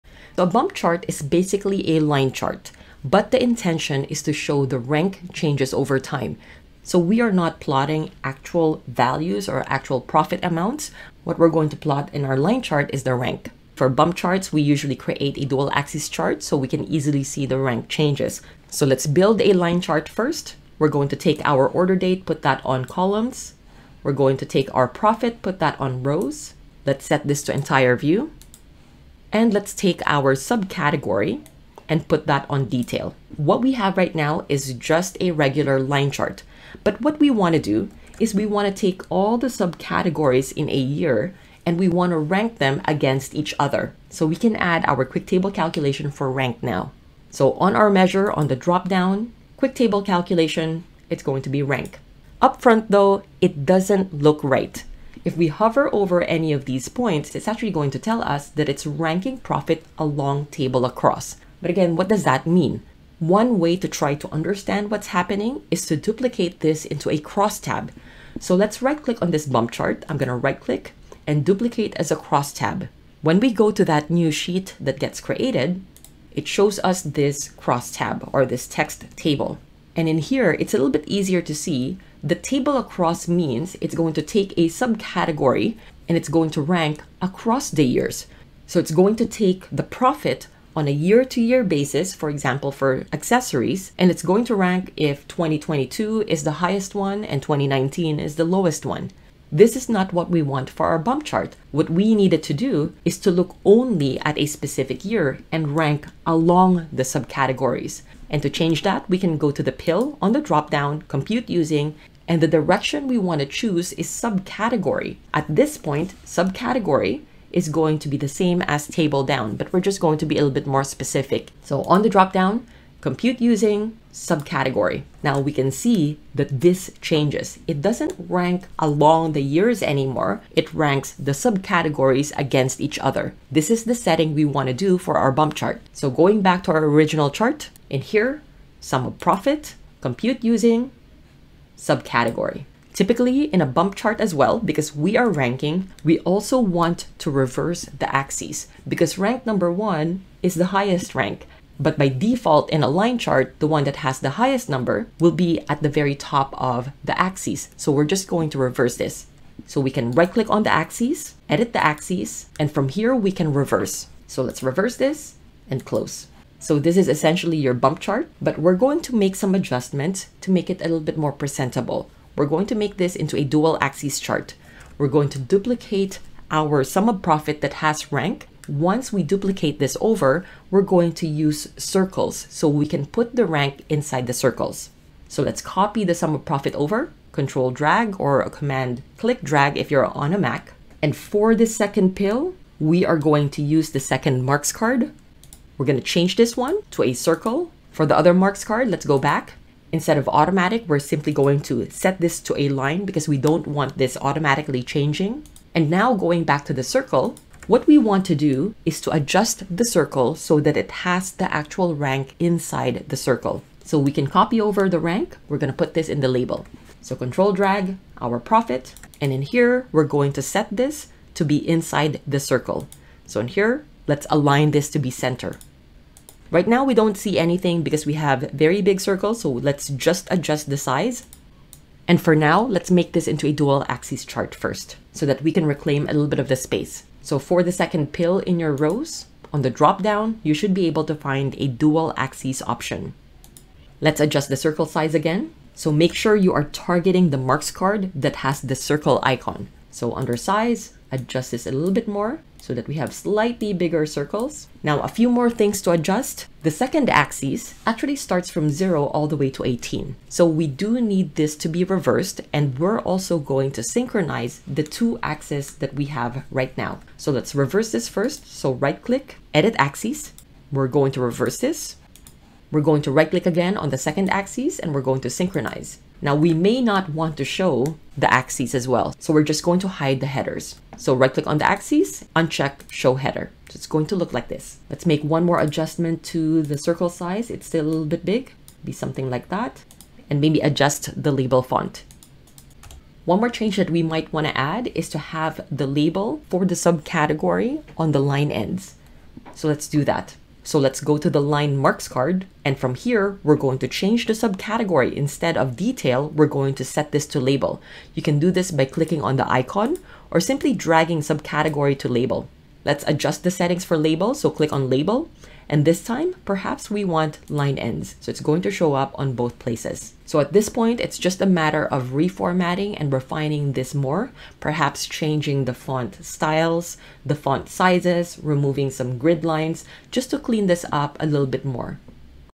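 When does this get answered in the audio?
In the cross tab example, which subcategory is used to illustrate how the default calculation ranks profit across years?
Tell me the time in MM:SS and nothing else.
01:33.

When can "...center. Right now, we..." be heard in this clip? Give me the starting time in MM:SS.
03:45.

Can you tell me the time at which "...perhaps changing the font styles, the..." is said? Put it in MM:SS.
05:24.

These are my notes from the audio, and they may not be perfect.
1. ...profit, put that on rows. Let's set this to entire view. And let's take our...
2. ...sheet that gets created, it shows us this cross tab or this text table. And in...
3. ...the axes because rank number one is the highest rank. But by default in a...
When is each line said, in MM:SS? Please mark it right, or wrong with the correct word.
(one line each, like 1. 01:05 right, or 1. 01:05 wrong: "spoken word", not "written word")
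1. 00:24 right
2. 01:14 right
3. 02:27 right.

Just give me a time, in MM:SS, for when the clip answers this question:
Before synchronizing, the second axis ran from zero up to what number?
04:19.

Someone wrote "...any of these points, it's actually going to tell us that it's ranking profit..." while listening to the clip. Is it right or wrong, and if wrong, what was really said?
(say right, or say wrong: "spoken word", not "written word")
right.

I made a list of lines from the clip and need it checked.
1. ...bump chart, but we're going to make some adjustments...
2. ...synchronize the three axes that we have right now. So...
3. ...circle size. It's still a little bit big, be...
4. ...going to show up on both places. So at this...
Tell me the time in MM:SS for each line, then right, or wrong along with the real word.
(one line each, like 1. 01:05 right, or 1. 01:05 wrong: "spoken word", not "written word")
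1. 02:47 right
2. 04:23 wrong: "two", not "three"
3. 04:46 right
4. 05:18 right.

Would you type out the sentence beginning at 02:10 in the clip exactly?
It ranks the subcategories against each other.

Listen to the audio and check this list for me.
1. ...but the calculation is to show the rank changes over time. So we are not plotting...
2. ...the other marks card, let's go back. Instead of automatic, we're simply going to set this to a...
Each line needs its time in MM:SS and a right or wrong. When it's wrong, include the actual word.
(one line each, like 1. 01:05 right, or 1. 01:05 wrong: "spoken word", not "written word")
1. 00:03 wrong: "intention", not "calculation"
2. 03:18 right.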